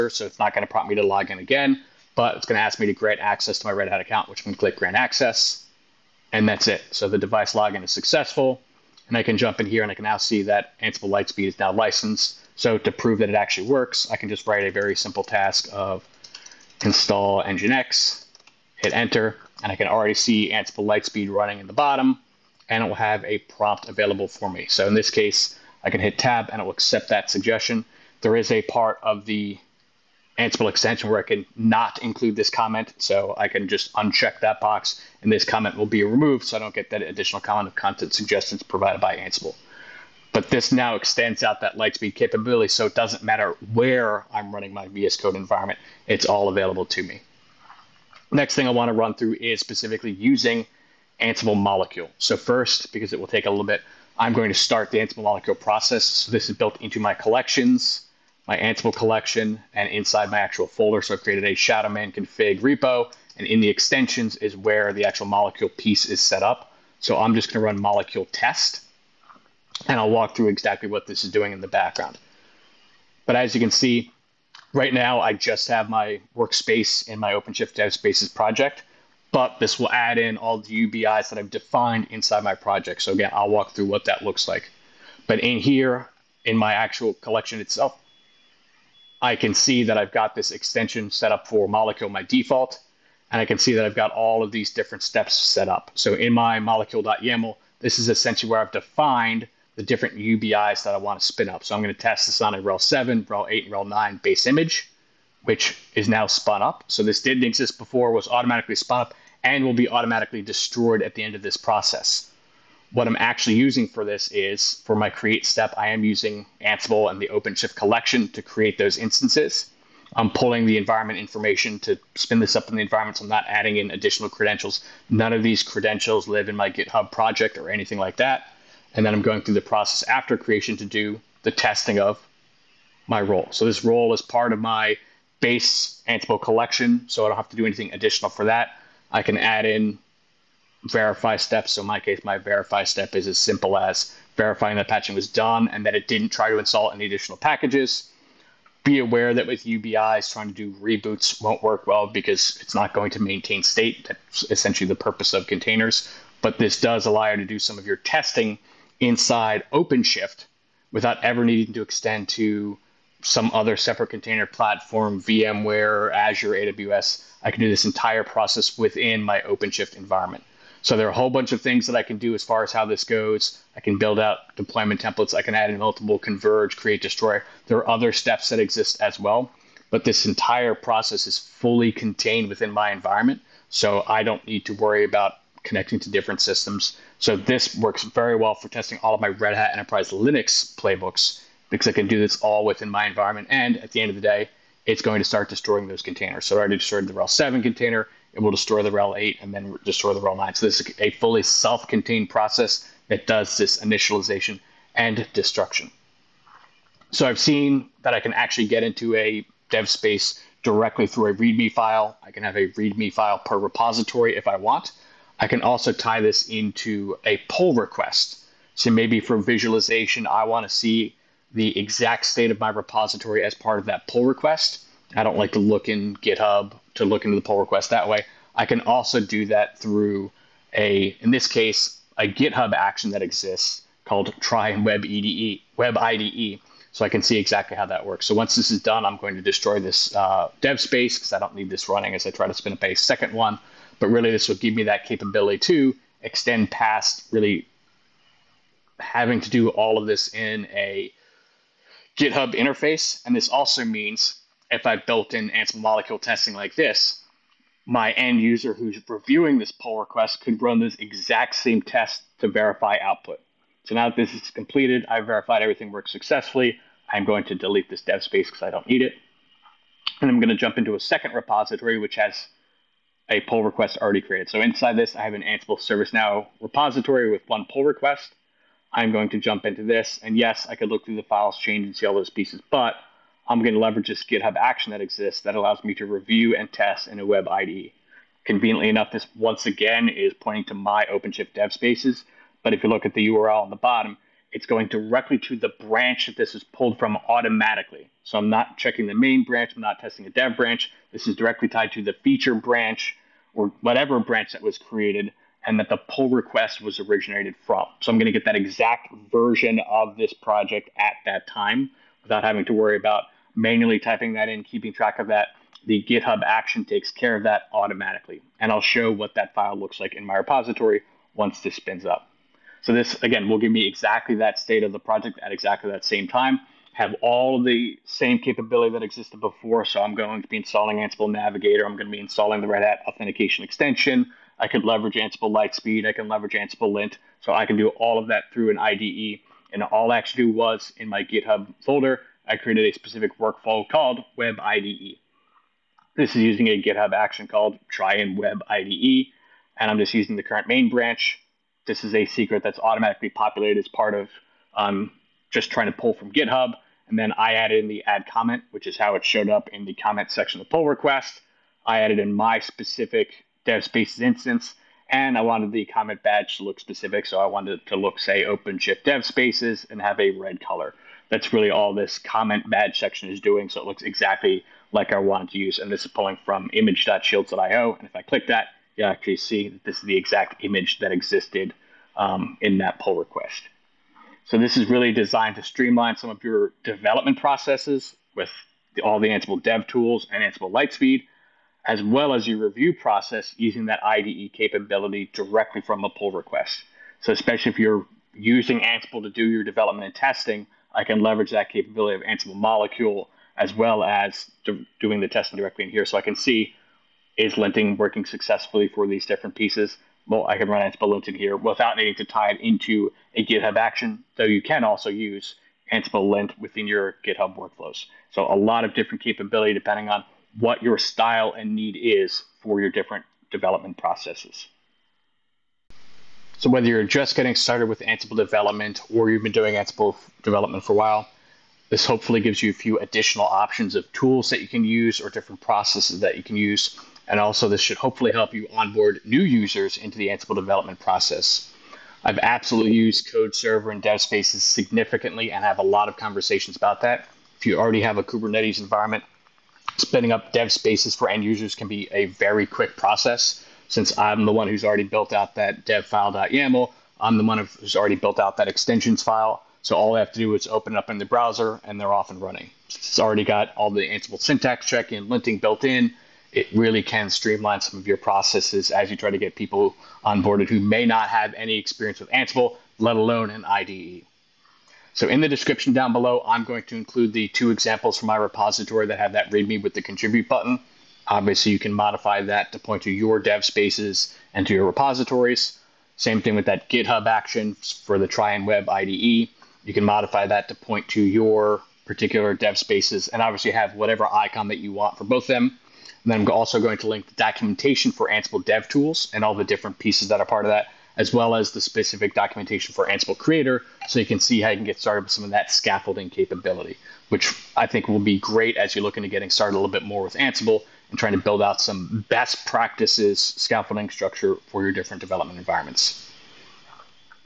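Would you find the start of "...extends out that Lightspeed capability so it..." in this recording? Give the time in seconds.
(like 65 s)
40 s.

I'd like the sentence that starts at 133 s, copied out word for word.
So this role is part of my base Ansible collection, so I don't have to do anything additional for that.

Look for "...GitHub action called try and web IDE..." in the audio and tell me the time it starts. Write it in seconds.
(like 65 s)
346 s.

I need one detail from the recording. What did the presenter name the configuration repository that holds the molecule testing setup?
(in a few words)
Shadowman config.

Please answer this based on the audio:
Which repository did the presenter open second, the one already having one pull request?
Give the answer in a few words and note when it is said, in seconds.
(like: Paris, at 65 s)
Ansible ServiceNow, at 275 s.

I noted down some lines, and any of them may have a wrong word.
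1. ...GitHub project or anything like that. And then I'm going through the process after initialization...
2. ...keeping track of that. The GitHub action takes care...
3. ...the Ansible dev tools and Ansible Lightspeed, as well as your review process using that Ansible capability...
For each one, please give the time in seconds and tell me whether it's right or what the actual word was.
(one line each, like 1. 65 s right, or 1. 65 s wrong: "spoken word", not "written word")
1. 126 s wrong: "creation", not "initialization"
2. 314 s right
3. 389 s wrong: "IDE", not "Ansible".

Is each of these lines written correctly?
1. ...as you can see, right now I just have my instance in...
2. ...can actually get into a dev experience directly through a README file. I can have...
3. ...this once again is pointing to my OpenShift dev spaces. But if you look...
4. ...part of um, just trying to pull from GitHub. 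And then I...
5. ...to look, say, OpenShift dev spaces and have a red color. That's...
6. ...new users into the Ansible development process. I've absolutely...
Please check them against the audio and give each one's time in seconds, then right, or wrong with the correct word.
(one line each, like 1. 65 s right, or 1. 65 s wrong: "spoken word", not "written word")
1. 73 s wrong: "workspace", not "instance"
2. 208 s wrong: "space", not "experience"
3. 289 s right
4. 353 s right
5. 367 s right
6. 439 s right.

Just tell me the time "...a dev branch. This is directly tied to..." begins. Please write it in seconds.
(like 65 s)
300 s.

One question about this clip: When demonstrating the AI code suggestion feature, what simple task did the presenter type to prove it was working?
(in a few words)
install Nginx.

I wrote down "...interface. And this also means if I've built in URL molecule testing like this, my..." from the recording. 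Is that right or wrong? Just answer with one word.
wrong.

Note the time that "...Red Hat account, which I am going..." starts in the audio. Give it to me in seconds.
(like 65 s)
3 s.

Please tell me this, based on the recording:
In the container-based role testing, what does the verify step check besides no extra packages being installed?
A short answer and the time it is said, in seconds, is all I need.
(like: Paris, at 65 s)
patching was done, at 144 s.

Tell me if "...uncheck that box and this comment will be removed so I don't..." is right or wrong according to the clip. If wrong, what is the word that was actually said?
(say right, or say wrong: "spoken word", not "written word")
right.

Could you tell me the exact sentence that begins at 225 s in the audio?
I don't like to look in GitHub to look into the pull request that way.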